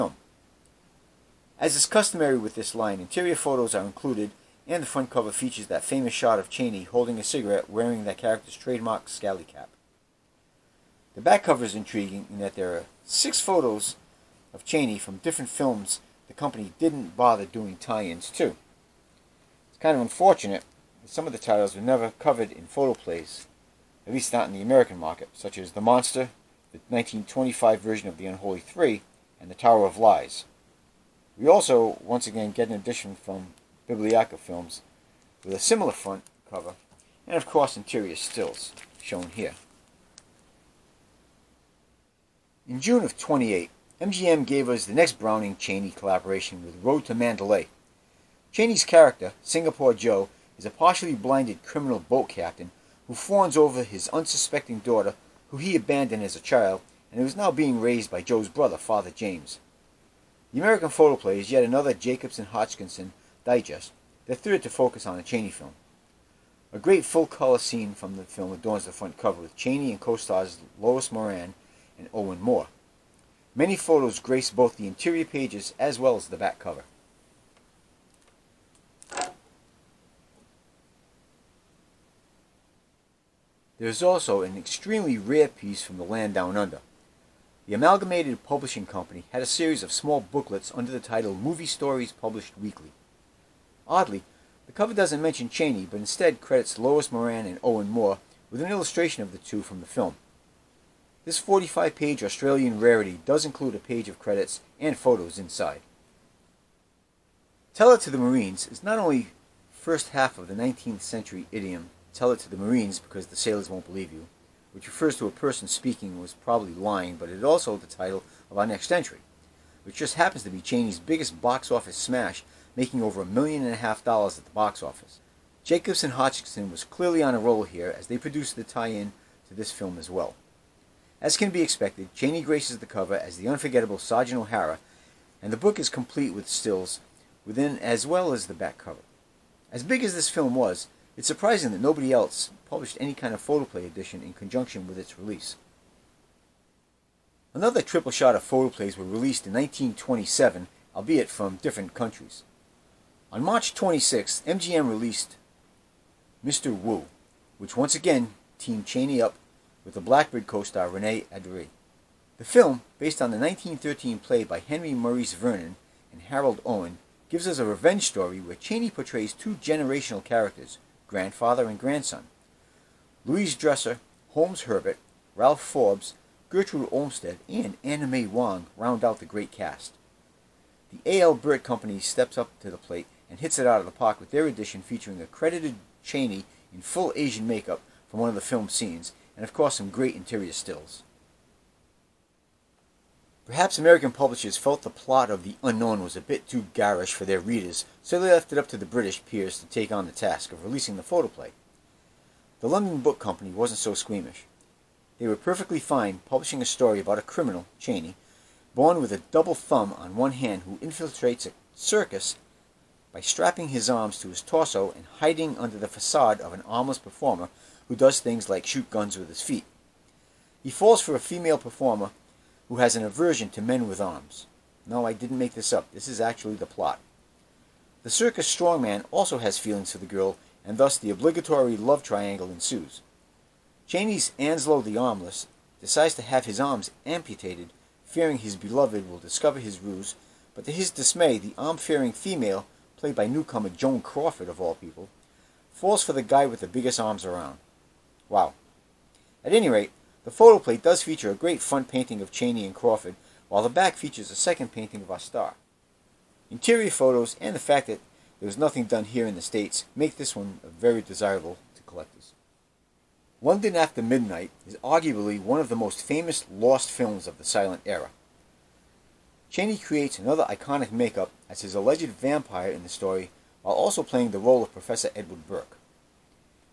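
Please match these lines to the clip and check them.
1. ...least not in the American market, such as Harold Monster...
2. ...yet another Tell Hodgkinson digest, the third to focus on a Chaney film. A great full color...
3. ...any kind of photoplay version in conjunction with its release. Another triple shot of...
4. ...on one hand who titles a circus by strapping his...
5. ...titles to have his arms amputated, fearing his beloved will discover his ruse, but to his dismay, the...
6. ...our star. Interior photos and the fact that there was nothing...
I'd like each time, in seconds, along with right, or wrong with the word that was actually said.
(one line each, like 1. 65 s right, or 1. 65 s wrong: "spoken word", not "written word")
1. 24 s wrong: "The", not "Harold"
2. 61 s wrong: "Jacobson", not "Tell"
3. 142 s wrong: "edition", not "version"
4. 209 s wrong: "infiltrates", not "titles"
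5. 235 s wrong: "decides", not "titles"
6. 255 s right.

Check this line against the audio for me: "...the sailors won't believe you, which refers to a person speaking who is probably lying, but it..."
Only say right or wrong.
right.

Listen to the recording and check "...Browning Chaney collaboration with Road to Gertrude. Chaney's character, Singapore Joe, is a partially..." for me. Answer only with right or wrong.
wrong.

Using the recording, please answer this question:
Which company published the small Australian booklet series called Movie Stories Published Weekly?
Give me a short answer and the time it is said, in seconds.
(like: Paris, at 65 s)
The Amalgamated Publishing Company, at 87 s.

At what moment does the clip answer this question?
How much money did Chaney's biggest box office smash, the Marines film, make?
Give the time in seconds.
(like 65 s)
123 s.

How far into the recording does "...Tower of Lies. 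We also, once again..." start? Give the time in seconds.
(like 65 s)
29 s.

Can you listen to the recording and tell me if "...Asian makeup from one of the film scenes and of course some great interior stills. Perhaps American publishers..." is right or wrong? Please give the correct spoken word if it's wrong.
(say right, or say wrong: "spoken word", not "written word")
right.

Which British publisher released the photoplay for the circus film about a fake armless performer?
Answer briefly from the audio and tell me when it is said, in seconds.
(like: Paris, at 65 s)
The London Book Company, at 202 s.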